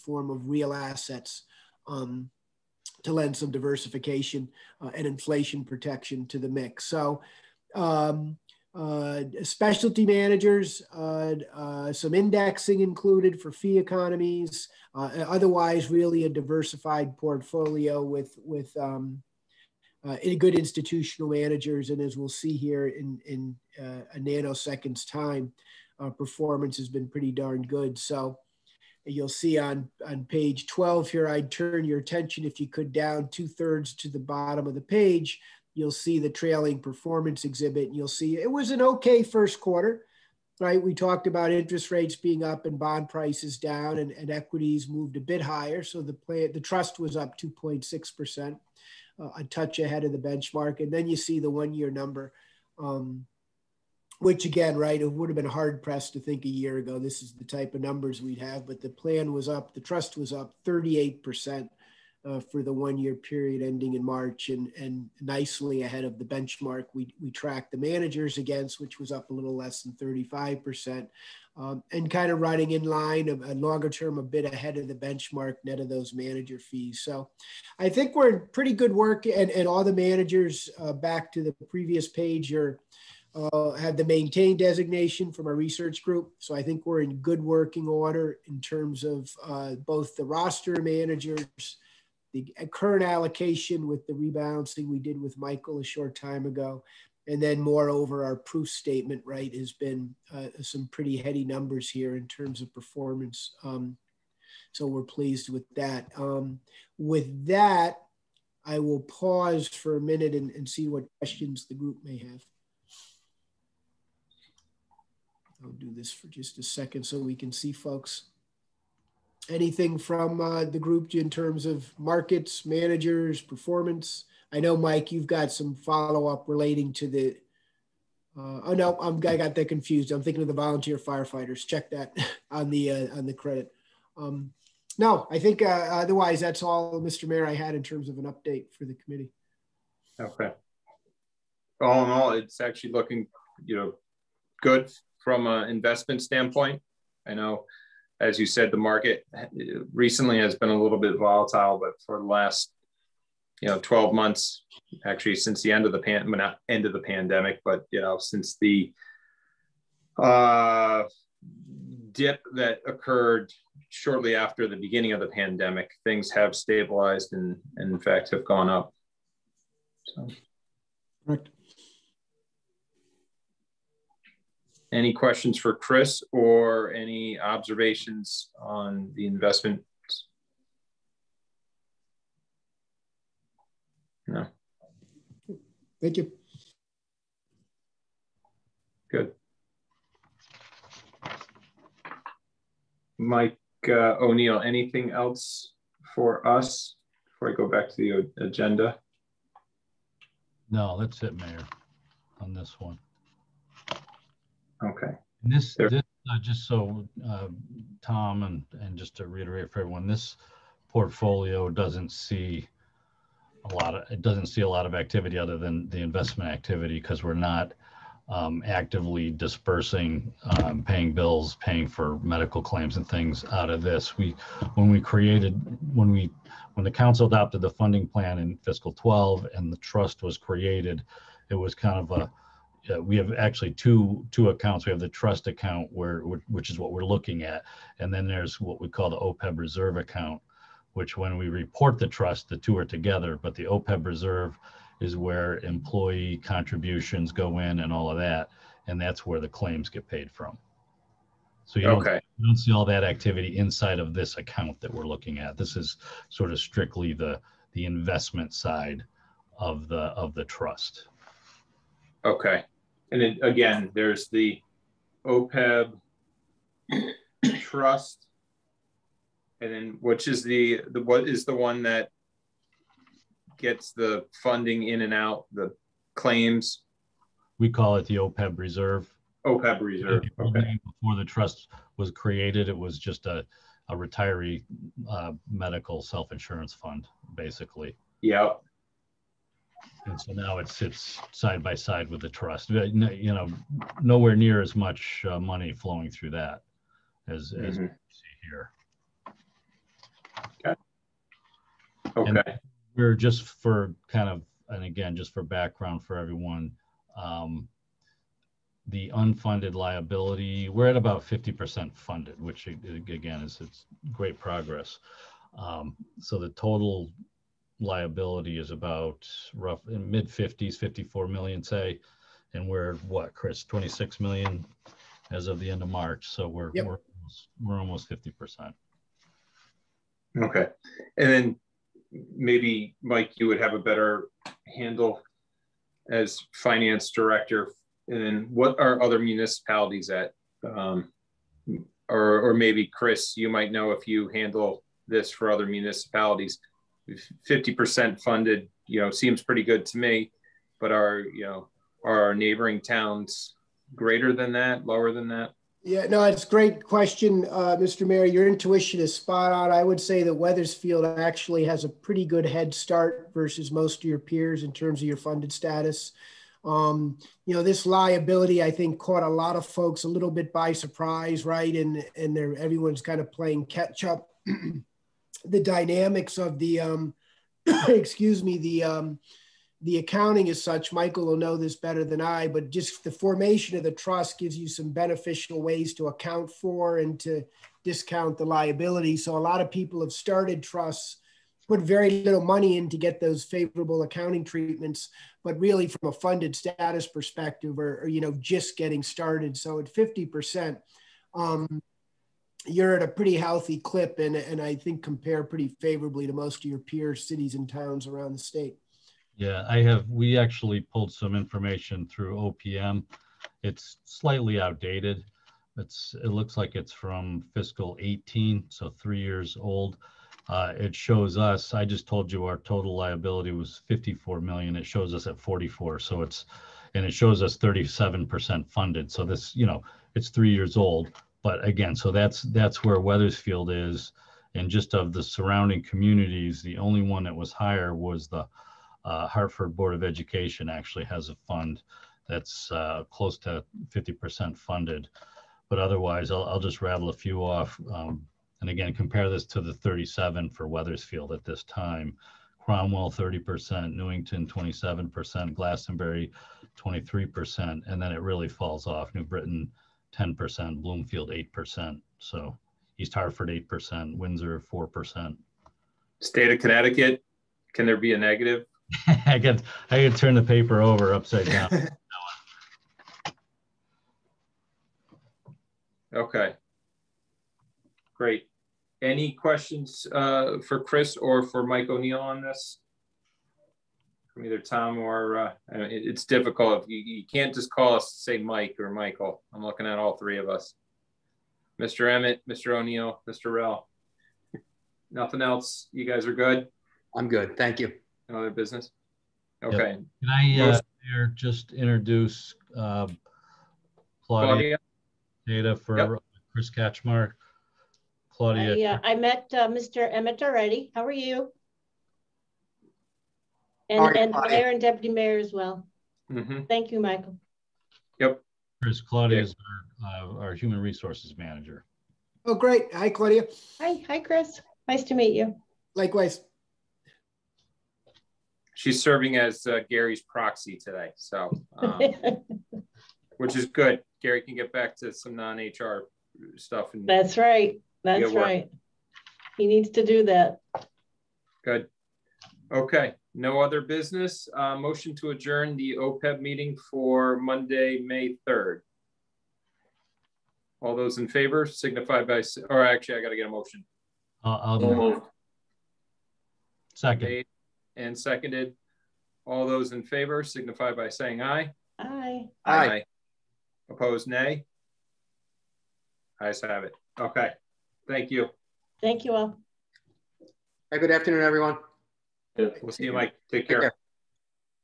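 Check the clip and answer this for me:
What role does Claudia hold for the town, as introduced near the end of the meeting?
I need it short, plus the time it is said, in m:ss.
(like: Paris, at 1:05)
human resources manager, at 8:40.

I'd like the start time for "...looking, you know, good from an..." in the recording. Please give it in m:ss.
2:22.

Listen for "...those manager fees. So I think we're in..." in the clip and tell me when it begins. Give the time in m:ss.
1:15.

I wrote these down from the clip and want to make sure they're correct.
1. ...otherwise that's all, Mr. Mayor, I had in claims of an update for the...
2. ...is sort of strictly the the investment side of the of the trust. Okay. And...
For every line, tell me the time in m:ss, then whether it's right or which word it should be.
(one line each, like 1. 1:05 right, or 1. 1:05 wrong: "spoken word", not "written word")
1. 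2:15 wrong: "terms", not "claims"
2. 4:15 right.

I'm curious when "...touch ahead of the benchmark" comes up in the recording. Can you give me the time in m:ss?
0:49.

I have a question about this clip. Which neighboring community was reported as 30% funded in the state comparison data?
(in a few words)
Cromwell.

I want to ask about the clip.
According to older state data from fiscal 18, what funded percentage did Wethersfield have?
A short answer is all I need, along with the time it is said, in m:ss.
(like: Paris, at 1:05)
37%, at 7:07.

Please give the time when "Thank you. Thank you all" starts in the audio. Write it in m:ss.
9:28.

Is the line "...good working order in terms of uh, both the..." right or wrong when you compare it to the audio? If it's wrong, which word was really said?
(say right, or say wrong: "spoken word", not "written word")
right.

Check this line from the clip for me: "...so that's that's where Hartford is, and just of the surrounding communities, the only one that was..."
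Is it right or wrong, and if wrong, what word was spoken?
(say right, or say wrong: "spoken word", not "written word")
wrong: "Wethersfield", not "Hartford".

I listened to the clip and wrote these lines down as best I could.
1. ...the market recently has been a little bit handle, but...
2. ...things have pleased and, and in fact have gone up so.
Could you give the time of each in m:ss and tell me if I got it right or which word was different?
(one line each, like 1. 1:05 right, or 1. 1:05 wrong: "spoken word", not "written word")
1. 2:28 wrong: "volatile", not "handle"
2. 2:46 wrong: "stabilized", not "pleased".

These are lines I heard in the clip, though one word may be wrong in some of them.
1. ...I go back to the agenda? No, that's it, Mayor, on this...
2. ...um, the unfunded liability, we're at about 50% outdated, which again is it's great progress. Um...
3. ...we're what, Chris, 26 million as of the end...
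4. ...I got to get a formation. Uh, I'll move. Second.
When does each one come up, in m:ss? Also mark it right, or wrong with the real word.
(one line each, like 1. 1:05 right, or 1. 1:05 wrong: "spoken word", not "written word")
1. 3:17 right
2. 5:07 wrong: "funded", not "outdated"
3. 5:22 right
4. 9:13 wrong: "motion", not "formation".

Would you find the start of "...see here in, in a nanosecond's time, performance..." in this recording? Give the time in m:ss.
0:22.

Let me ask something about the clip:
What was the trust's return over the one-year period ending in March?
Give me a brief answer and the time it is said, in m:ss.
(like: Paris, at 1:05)
38%, at 1:00.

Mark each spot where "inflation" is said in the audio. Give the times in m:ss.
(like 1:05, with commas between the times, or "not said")
0:05.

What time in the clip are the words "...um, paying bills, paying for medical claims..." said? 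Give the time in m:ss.
3:40.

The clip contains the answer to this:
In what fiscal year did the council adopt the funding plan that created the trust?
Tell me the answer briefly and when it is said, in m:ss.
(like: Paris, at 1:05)
fiscal 12, at 3:48.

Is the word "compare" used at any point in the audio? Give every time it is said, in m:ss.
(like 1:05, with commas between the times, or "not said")
6:45, 7:28.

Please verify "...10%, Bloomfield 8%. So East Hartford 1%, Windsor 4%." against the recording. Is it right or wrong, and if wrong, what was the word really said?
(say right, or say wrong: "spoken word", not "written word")
wrong: "8", not "1".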